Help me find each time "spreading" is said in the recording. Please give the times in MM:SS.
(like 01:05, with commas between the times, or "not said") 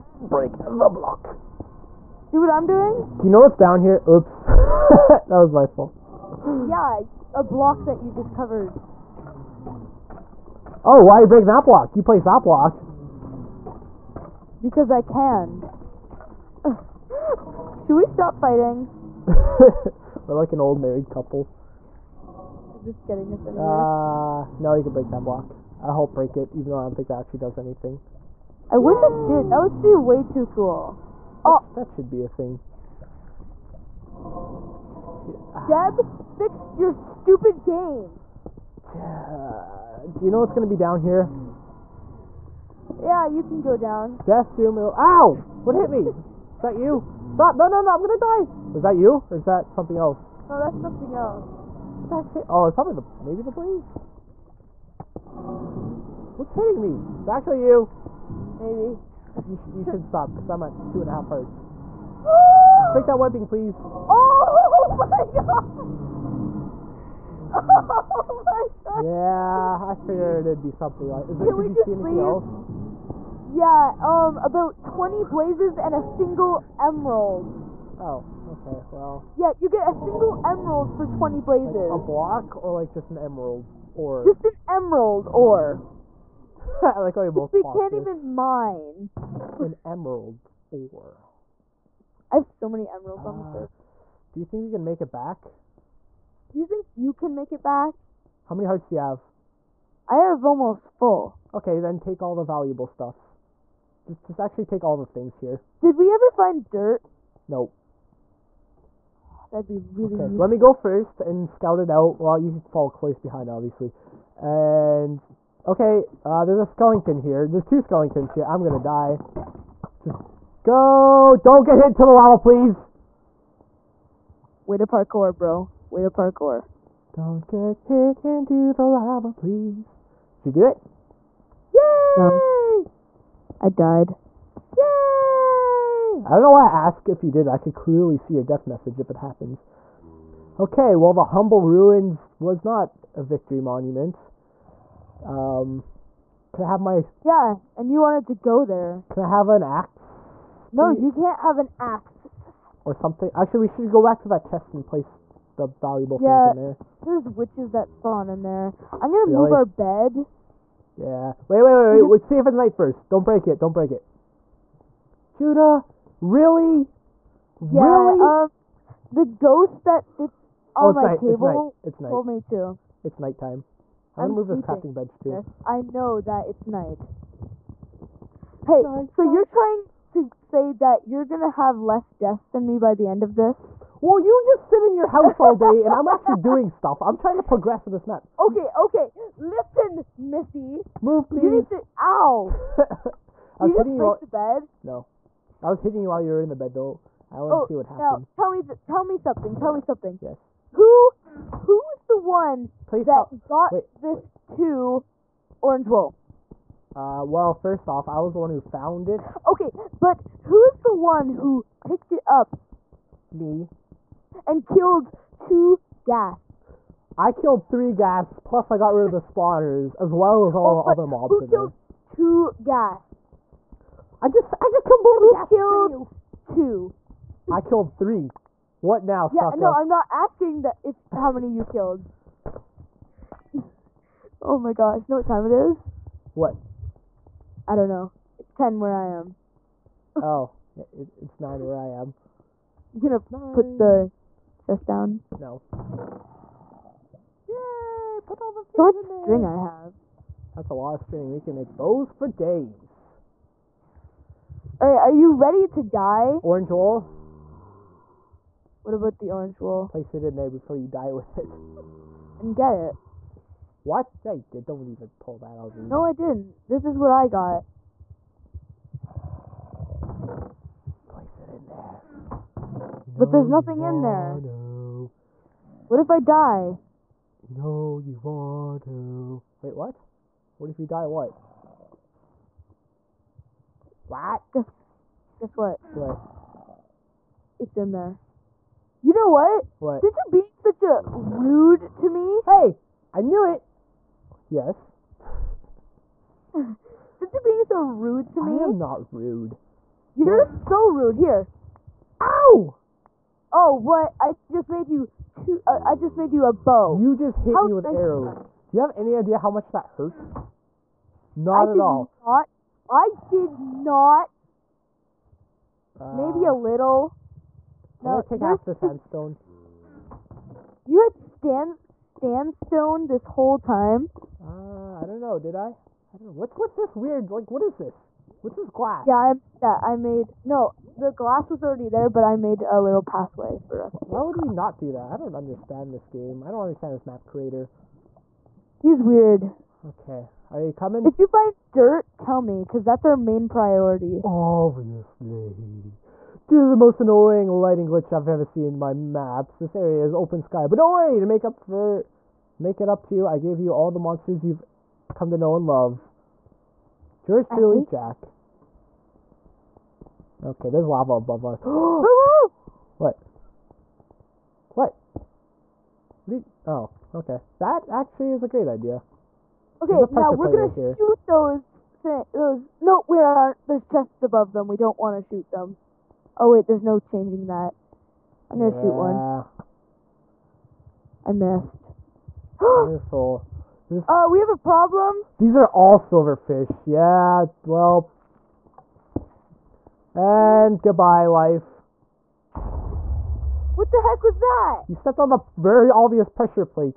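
not said.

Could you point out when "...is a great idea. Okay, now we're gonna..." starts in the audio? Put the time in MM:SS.
06:08.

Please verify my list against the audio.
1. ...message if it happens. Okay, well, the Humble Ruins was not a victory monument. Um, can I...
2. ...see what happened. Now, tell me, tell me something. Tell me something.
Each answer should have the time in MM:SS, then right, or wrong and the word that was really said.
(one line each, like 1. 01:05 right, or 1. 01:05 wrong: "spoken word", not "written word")
1. 02:18 right
2. 03:17 right.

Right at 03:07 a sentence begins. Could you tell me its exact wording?
I'm trying to progress in this map.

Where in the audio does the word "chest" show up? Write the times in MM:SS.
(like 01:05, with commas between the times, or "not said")
02:34, 04:04, 06:13.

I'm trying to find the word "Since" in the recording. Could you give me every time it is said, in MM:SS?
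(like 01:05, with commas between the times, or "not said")
04:50, 04:56.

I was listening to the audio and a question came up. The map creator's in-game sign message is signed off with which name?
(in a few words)
Jack.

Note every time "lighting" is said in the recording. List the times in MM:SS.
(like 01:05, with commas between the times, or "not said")
05:47.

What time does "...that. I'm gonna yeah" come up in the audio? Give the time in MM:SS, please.
06:17.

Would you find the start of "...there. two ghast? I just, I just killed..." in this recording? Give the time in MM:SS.
03:41.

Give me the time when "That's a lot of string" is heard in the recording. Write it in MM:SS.
04:10.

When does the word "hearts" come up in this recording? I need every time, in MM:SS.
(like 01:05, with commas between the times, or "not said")
01:01, 01:38.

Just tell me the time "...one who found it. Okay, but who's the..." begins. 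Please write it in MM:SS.
03:28.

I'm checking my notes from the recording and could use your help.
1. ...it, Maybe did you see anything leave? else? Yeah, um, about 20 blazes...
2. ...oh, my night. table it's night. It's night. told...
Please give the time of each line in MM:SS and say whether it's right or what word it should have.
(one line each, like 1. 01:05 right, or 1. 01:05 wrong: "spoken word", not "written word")
1. 01:11 wrong: "Can", not "Maybe"
2. 02:50 right.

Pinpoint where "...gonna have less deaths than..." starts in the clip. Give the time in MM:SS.
03:01.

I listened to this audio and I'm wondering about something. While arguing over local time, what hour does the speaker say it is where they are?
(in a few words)
9.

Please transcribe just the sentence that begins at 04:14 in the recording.
All right, are you ready to die?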